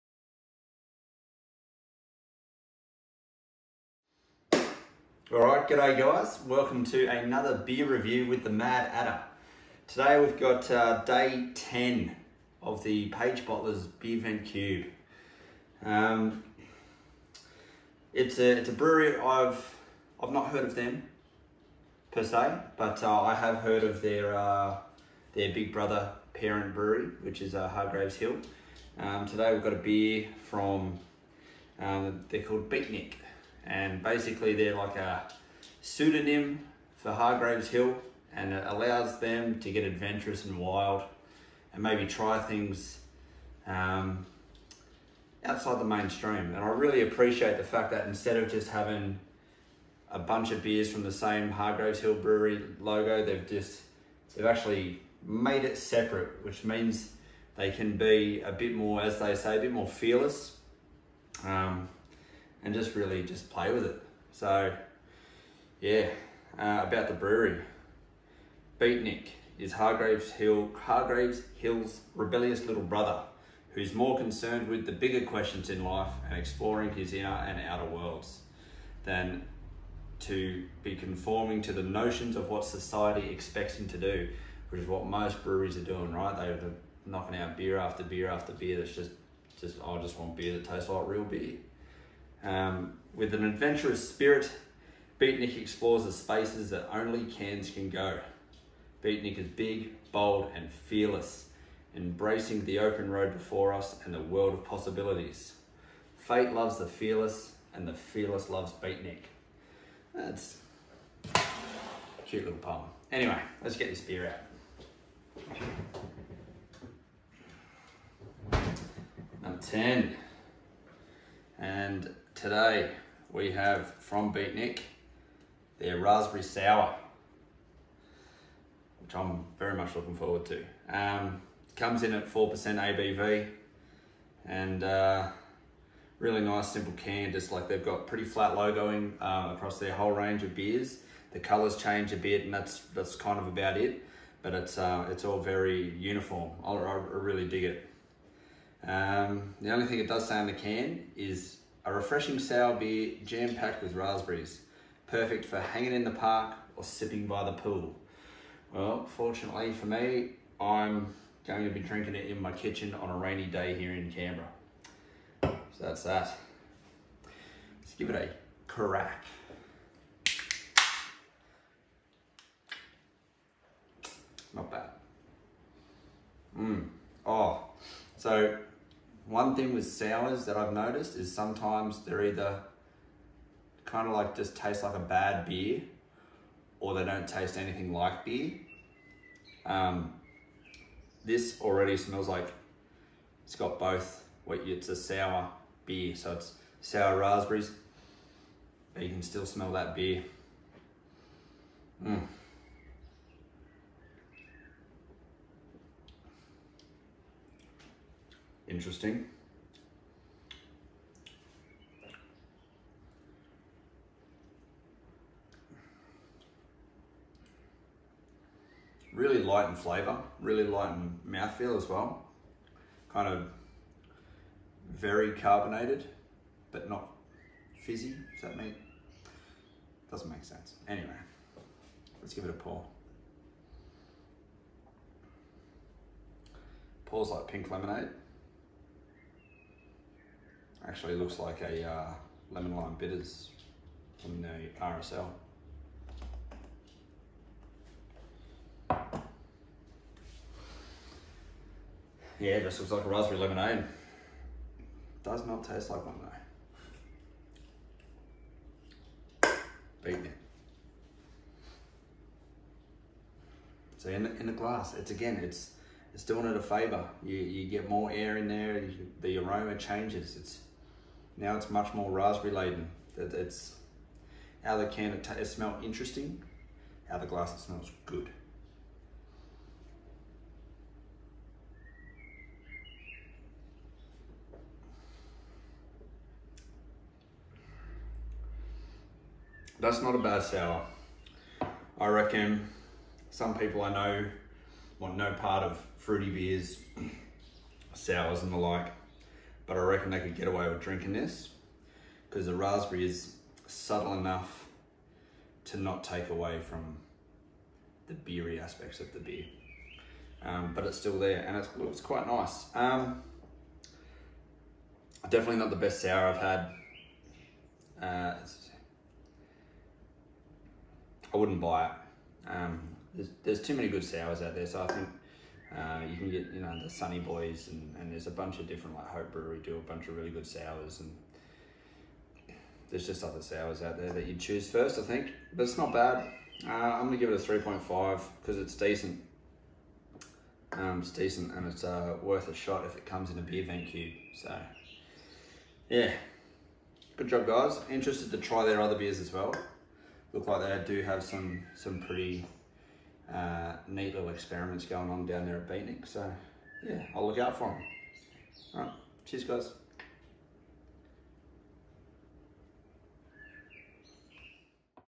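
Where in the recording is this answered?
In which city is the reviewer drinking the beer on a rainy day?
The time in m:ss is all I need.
2:44.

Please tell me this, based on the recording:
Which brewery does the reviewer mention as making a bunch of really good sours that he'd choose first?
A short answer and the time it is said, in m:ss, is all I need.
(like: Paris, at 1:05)
Hope Brewery, at 5:29.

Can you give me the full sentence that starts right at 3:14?
What it's a sour beer, so it's sour raspberries, but you can still smell that beer.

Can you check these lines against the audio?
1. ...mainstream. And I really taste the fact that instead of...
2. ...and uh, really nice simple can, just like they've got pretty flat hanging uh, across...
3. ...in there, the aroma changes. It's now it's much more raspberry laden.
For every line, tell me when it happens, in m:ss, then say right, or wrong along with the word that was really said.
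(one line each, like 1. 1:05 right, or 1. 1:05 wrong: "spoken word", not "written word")
1. 0:45 wrong: "appreciate", not "taste"
2. 2:14 wrong: "logoing", not "hanging"
3. 4:28 right.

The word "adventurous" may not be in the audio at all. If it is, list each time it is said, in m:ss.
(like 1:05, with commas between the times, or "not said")
0:39, 1:33.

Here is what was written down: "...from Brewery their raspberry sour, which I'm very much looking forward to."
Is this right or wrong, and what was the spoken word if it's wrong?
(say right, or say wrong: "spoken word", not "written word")
wrong: "Beatnik", not "Brewery".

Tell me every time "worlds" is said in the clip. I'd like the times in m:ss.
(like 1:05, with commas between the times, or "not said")
1:17, 1:44.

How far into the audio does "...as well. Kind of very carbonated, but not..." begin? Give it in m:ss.
3:41.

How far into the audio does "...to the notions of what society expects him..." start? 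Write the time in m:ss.
1:21.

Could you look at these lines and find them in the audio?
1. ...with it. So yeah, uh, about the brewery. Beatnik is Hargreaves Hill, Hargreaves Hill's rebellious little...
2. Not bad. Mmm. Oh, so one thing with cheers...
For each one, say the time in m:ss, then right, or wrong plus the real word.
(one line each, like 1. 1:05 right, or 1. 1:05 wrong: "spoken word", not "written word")
1. 1:03 right
2. 2:54 wrong: "sours", not "cheers".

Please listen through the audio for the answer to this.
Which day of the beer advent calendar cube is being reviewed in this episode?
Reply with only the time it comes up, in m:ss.
0:11.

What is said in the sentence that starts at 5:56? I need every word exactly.
So yeah, I'll look out for them.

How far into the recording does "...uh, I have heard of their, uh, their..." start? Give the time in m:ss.
0:23.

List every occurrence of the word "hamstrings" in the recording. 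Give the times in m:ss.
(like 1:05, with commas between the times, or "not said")
not said.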